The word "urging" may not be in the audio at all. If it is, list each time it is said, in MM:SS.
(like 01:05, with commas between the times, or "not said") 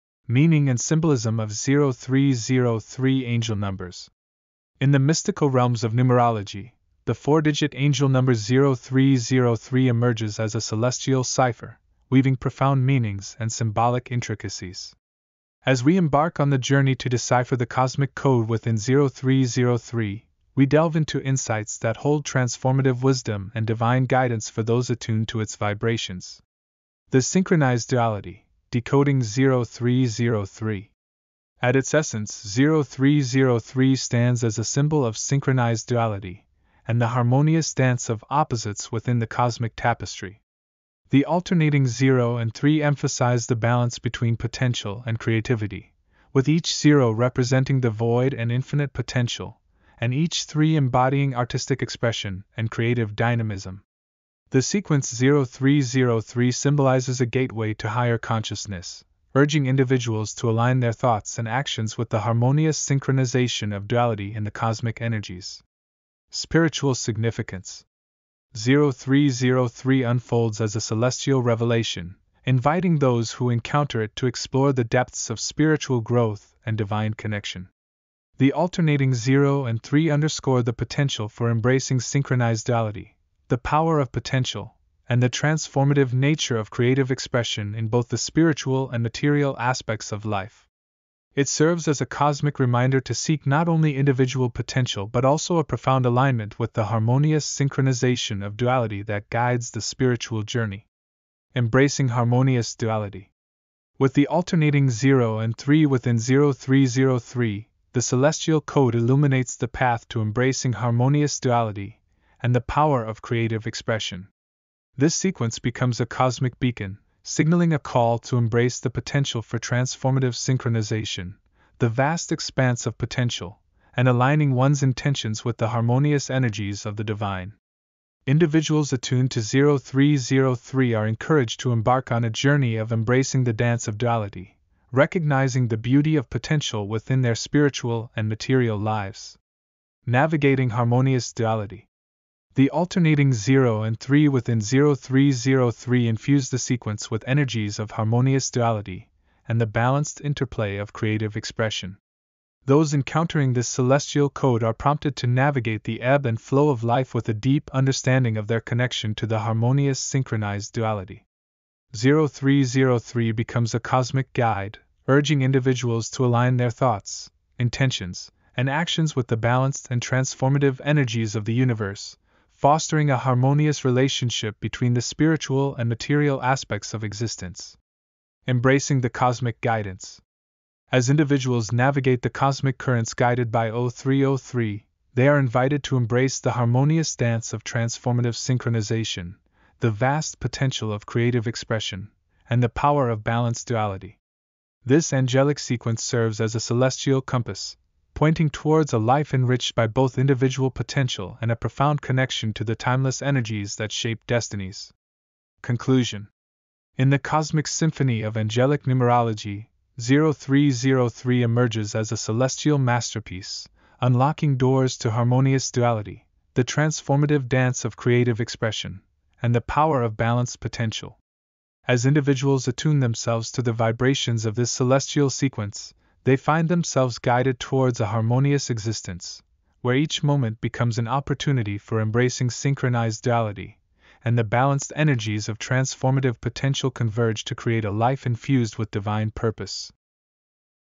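00:59, 02:45.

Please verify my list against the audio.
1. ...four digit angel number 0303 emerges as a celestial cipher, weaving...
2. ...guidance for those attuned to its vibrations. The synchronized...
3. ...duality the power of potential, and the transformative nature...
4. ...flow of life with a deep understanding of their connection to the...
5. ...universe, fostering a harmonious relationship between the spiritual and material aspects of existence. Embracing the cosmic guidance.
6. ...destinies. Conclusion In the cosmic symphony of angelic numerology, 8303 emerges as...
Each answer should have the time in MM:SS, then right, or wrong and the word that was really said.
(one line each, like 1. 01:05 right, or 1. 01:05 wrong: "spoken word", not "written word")
1. 00:07 right
2. 00:24 right
3. 01:22 right
4. 02:36 right
5. 02:51 right
6. 03:24 wrong: "0303", not "8303".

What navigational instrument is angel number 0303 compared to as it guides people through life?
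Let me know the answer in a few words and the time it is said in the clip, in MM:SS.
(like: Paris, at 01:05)
Celestial compass, at 03:16.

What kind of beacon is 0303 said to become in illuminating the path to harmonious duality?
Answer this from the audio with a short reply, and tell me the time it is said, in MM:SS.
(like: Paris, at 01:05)
Cosmic beacon, at 01:56.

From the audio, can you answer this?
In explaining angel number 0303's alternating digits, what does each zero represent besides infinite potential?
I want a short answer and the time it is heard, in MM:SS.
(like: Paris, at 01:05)
The void, at 00:47.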